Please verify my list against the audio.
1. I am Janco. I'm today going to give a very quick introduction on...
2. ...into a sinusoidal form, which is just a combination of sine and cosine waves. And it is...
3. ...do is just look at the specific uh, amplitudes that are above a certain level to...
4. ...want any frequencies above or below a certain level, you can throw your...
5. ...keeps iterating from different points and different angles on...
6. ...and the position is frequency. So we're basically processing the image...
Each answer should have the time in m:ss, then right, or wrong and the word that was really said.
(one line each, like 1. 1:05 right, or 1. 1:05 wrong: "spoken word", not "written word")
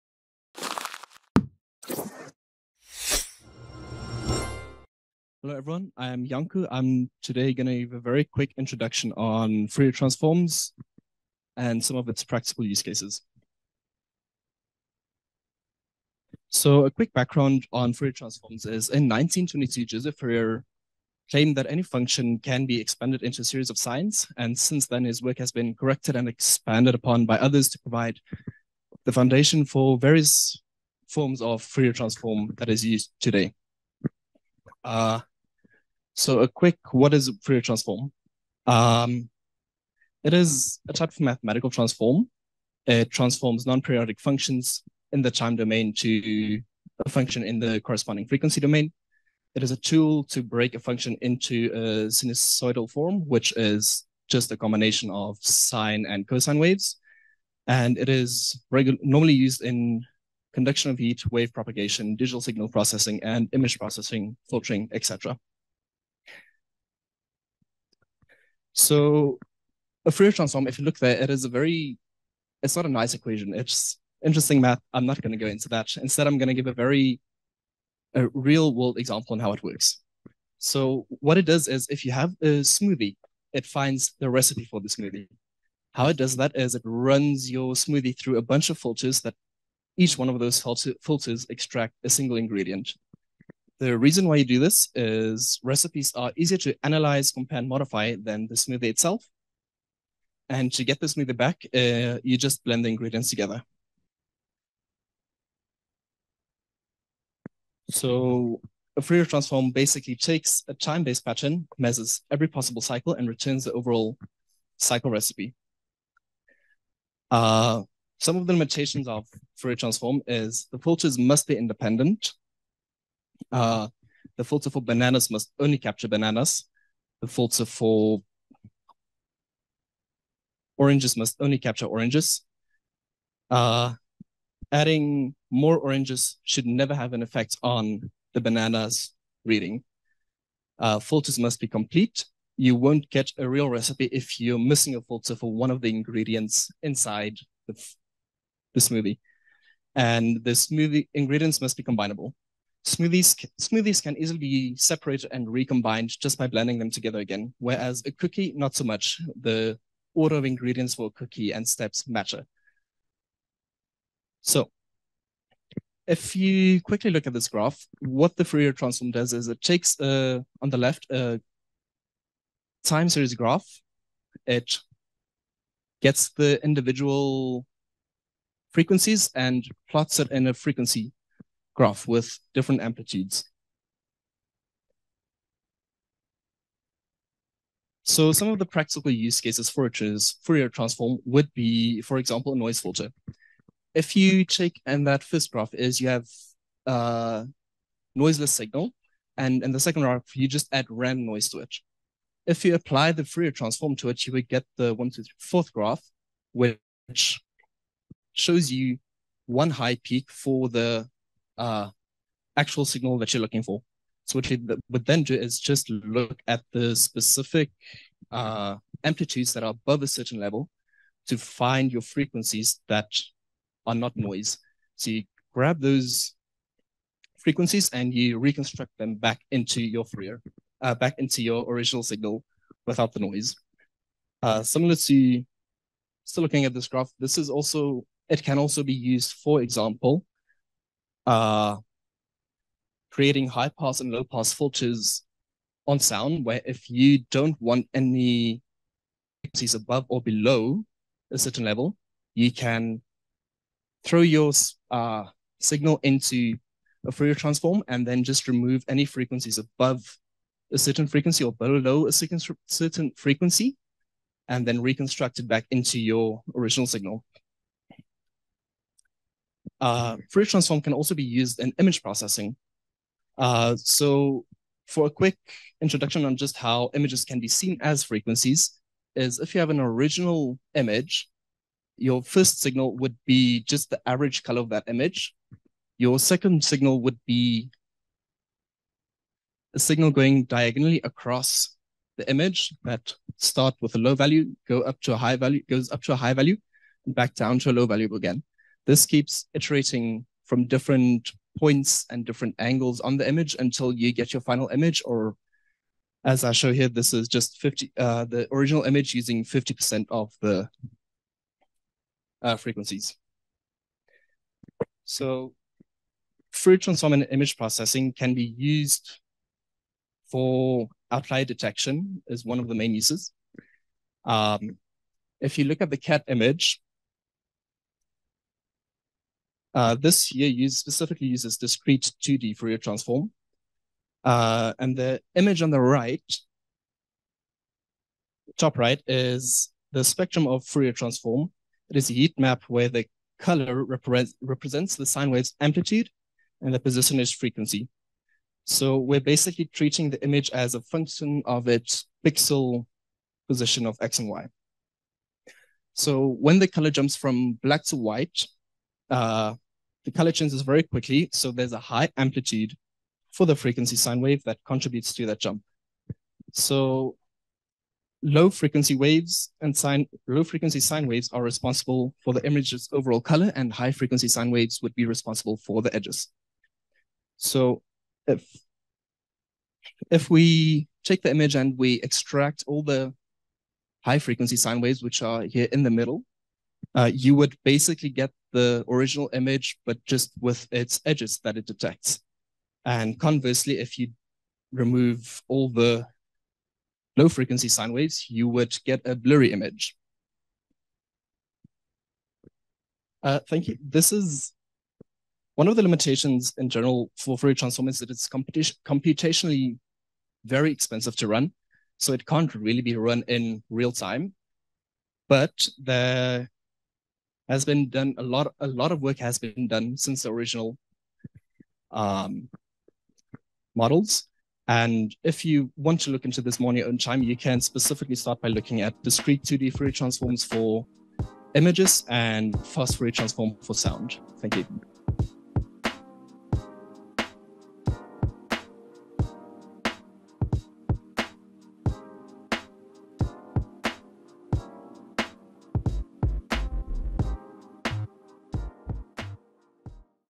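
1. 0:05 right
2. 0:51 right
3. 3:35 right
4. 4:07 right
5. 4:59 right
6. 5:46 wrong: "treating", not "processing".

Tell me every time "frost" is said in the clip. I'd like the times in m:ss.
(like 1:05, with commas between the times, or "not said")
not said.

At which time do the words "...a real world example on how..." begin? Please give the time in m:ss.
1:18.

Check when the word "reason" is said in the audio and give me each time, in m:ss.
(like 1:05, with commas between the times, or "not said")
1:33.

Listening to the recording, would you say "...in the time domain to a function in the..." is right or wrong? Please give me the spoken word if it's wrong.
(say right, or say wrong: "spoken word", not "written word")
right.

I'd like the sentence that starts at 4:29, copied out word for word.
Uh, Fourier transform can also be used in image processing.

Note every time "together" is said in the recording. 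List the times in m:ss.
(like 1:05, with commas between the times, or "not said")
1:43, 2:36.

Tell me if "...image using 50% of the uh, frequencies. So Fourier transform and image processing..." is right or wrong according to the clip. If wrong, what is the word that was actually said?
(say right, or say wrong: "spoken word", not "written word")
right.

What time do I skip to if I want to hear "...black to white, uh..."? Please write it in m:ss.
5:57.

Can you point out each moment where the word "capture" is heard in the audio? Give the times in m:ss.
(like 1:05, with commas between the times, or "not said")
2:05, 2:11.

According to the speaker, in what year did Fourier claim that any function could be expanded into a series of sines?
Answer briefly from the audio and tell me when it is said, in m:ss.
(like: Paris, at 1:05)
1922, at 0:19.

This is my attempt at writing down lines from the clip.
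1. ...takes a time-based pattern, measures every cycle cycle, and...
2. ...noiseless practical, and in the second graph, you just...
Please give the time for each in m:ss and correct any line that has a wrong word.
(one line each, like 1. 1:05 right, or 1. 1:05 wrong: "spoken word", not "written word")
1. 1:50 wrong: "possible", not "cycle"
2. 3:18 wrong: "signal", not "practical".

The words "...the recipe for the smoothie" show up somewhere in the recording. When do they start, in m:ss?
1:24.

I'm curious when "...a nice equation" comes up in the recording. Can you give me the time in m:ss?
1:12.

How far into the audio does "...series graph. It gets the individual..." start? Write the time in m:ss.
2:53.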